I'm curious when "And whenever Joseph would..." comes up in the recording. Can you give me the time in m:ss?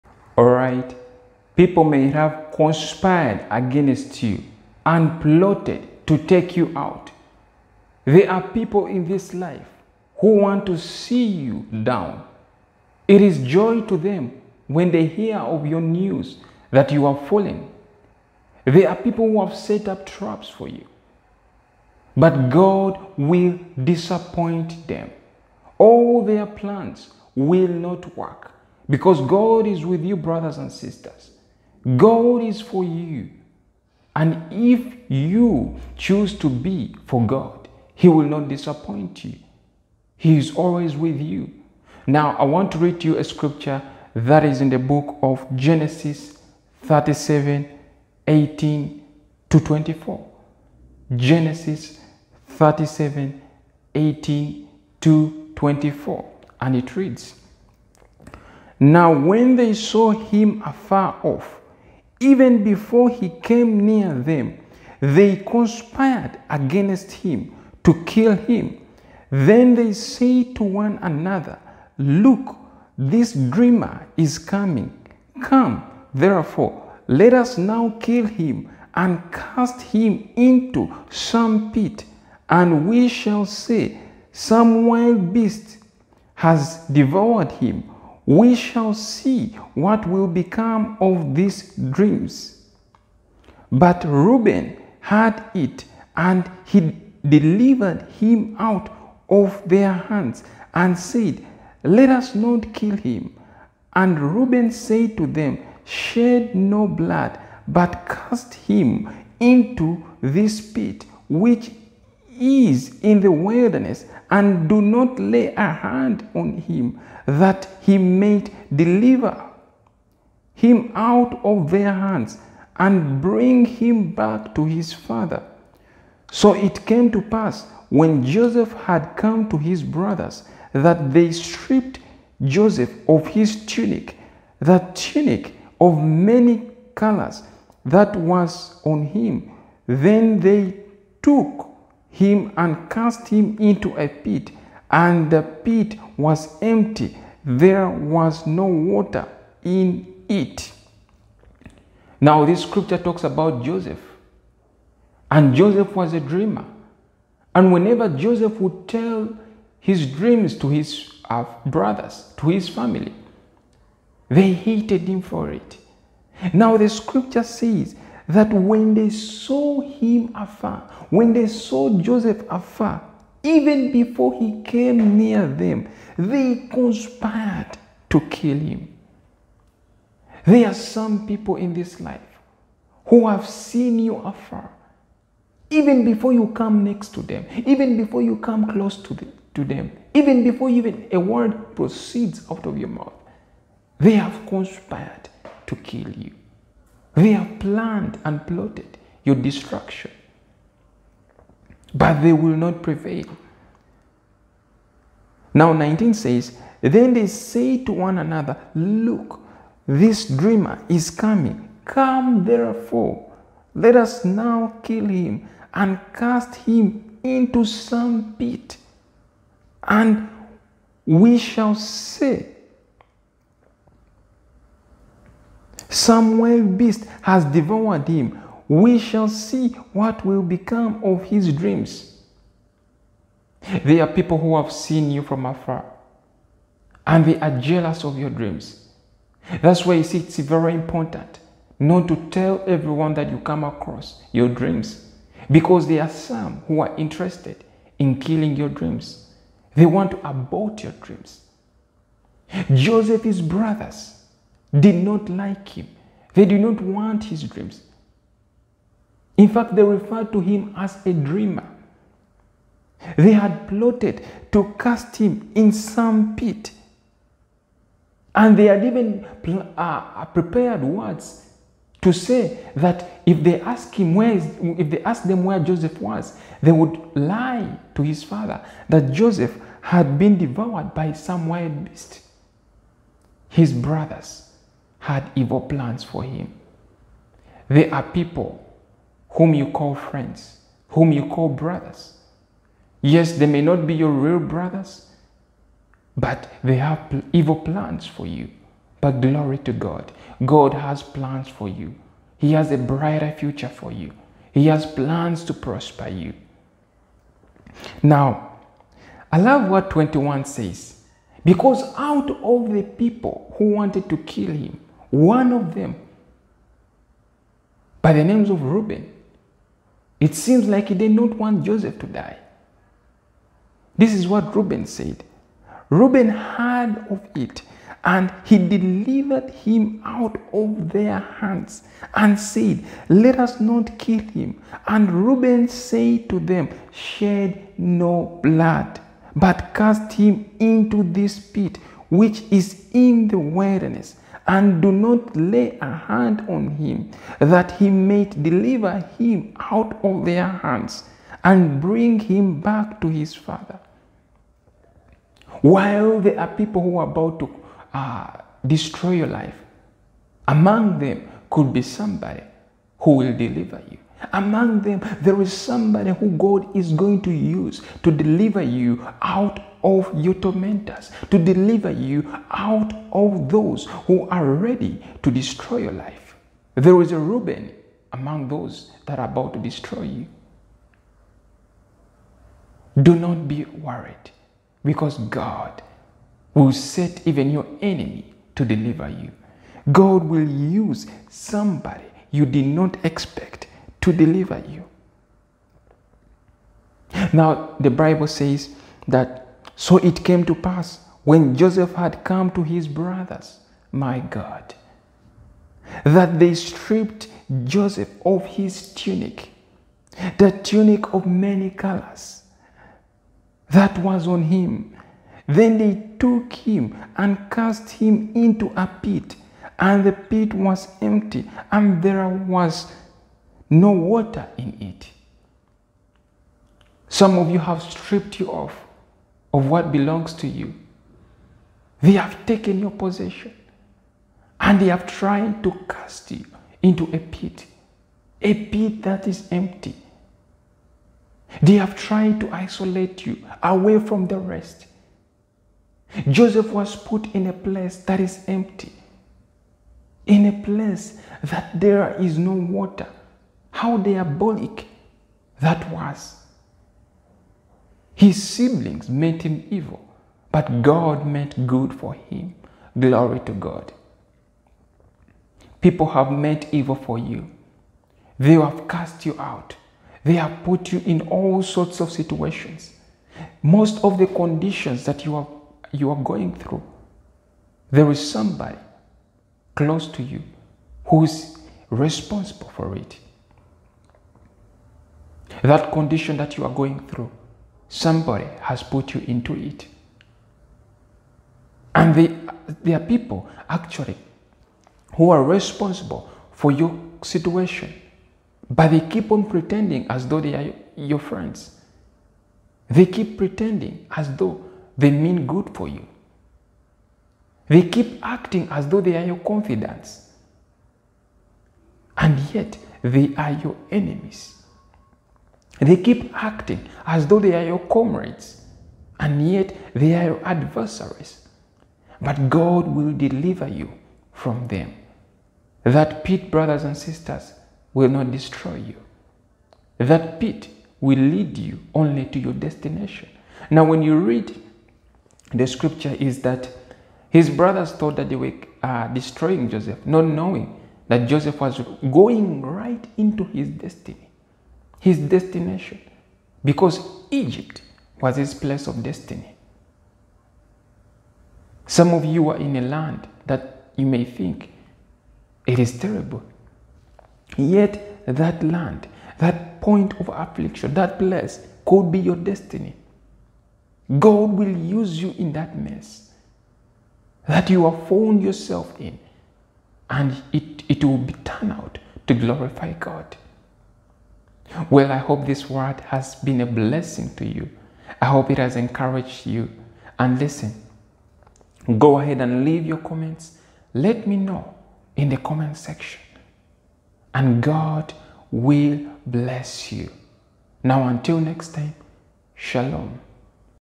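2:37.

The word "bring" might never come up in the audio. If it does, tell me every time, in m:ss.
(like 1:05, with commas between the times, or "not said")
2:03, 5:51.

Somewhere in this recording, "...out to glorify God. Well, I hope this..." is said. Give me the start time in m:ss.
9:31.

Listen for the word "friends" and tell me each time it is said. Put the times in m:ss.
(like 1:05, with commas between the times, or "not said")
4:49, 8:21.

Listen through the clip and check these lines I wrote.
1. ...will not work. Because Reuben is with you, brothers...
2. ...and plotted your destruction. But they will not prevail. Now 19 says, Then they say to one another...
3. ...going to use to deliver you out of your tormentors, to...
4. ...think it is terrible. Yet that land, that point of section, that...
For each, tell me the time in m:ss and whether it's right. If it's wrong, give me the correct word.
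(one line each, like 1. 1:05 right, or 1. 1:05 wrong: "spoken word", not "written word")
1. 0:27 wrong: "God", not "Reuben"
2. 3:18 right
3. 6:06 right
4. 9:14 wrong: "affliction", not "section".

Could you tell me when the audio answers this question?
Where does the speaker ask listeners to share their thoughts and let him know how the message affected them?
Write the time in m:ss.
9:45.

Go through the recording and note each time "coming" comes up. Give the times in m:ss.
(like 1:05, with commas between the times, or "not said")
1:14, 3:31.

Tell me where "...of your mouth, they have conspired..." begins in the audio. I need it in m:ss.
3:12.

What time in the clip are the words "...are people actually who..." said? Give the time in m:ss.
8:12.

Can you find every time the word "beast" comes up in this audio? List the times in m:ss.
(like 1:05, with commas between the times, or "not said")
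1:25, 3:46, 4:41.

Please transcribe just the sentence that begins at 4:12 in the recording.
Joseph's brothers did not like him.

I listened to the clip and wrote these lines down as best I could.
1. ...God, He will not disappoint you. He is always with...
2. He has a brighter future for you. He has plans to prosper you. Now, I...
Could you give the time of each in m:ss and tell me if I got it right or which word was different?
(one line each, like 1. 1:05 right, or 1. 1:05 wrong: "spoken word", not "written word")
1. 0:37 right
2. 5:02 right.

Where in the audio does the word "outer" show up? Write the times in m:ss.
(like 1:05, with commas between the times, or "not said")
not said.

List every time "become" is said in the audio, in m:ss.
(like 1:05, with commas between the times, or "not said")
1:30, 3:50.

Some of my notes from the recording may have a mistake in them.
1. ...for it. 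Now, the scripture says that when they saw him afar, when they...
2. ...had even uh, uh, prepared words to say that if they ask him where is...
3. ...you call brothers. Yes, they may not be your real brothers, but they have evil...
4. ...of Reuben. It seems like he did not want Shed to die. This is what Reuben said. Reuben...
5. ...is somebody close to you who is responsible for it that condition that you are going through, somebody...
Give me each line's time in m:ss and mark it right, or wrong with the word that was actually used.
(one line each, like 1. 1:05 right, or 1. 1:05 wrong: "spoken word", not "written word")
1. 2:45 right
2. 4:28 right
3. 4:51 right
4. 5:18 wrong: "Joseph", not "Shed"
5. 7:58 right.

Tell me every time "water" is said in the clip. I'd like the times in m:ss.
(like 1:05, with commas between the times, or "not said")
2:28, 7:03, 7:32.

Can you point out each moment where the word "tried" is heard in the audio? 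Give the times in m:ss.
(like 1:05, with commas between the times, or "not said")
7:15, 7:21.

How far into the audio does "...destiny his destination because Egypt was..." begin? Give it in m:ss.
9:03.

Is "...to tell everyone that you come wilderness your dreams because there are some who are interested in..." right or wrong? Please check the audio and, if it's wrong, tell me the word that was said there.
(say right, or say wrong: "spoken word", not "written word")
wrong: "across", not "wilderness".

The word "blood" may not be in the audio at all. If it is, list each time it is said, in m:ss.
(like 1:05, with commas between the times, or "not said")
1:46, 5:38.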